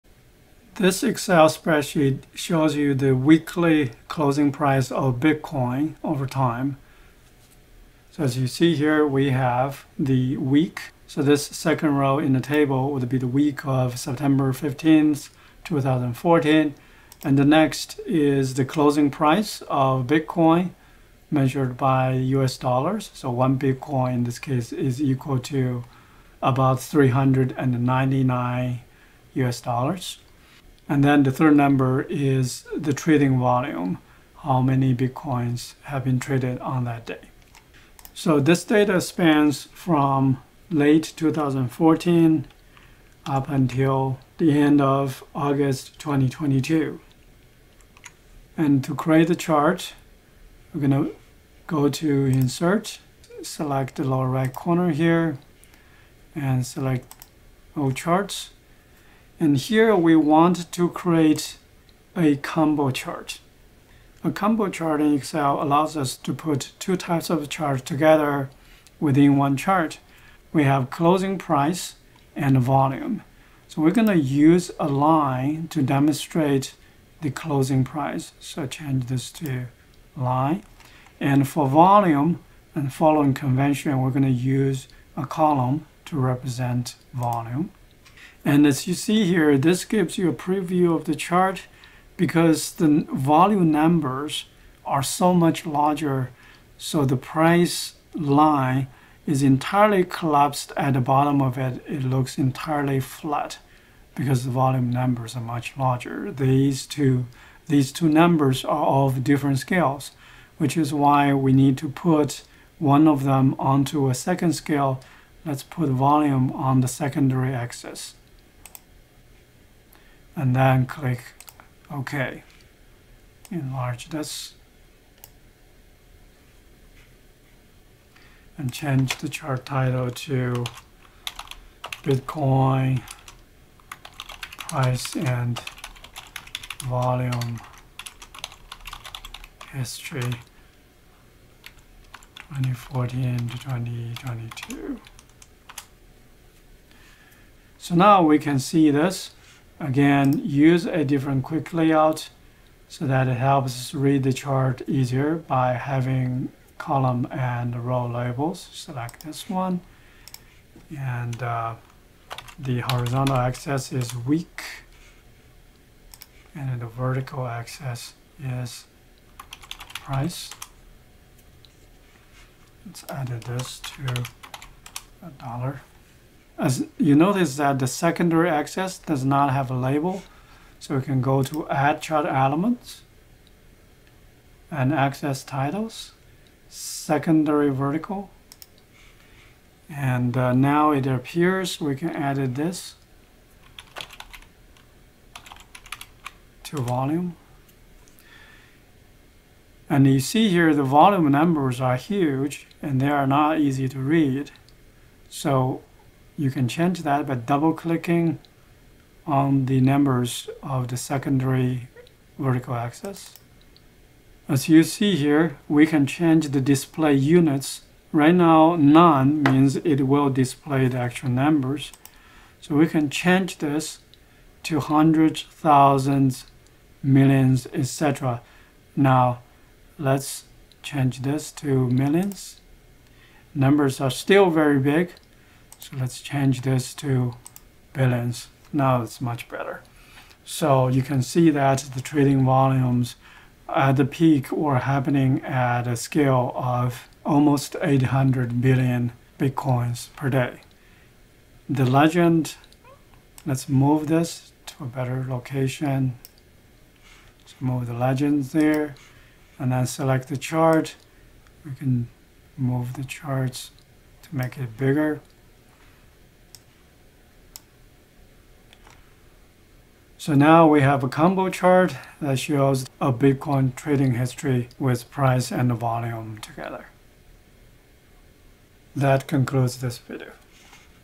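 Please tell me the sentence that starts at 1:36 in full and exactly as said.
So the price line is entirely collapsed at the bottom of it.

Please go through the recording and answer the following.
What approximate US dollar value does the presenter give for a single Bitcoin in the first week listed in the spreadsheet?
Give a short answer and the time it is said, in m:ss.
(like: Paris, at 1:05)
$399, at 0:26.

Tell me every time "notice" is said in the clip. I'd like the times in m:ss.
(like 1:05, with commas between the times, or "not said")
2:57.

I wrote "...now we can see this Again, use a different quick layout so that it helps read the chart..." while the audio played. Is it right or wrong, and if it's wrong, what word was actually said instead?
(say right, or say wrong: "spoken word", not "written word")
right.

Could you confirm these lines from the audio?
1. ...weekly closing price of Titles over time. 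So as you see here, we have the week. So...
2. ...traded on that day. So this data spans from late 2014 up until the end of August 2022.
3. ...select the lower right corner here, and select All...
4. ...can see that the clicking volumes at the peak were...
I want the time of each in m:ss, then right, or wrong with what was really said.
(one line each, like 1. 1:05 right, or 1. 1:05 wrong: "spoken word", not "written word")
1. 0:03 wrong: "Bitcoin", not "Titles"
2. 0:36 right
3. 0:53 right
4. 4:01 wrong: "trading", not "clicking".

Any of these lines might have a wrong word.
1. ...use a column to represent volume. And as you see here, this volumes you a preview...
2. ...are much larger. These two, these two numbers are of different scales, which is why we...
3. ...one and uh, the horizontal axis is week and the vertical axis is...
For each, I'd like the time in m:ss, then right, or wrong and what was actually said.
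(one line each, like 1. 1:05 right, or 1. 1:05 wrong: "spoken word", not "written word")
1. 1:24 wrong: "gives", not "volumes"
2. 1:45 right
3. 2:39 right.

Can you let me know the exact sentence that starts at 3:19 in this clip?
And you see here the volume numbers are huge and they are not easy to read.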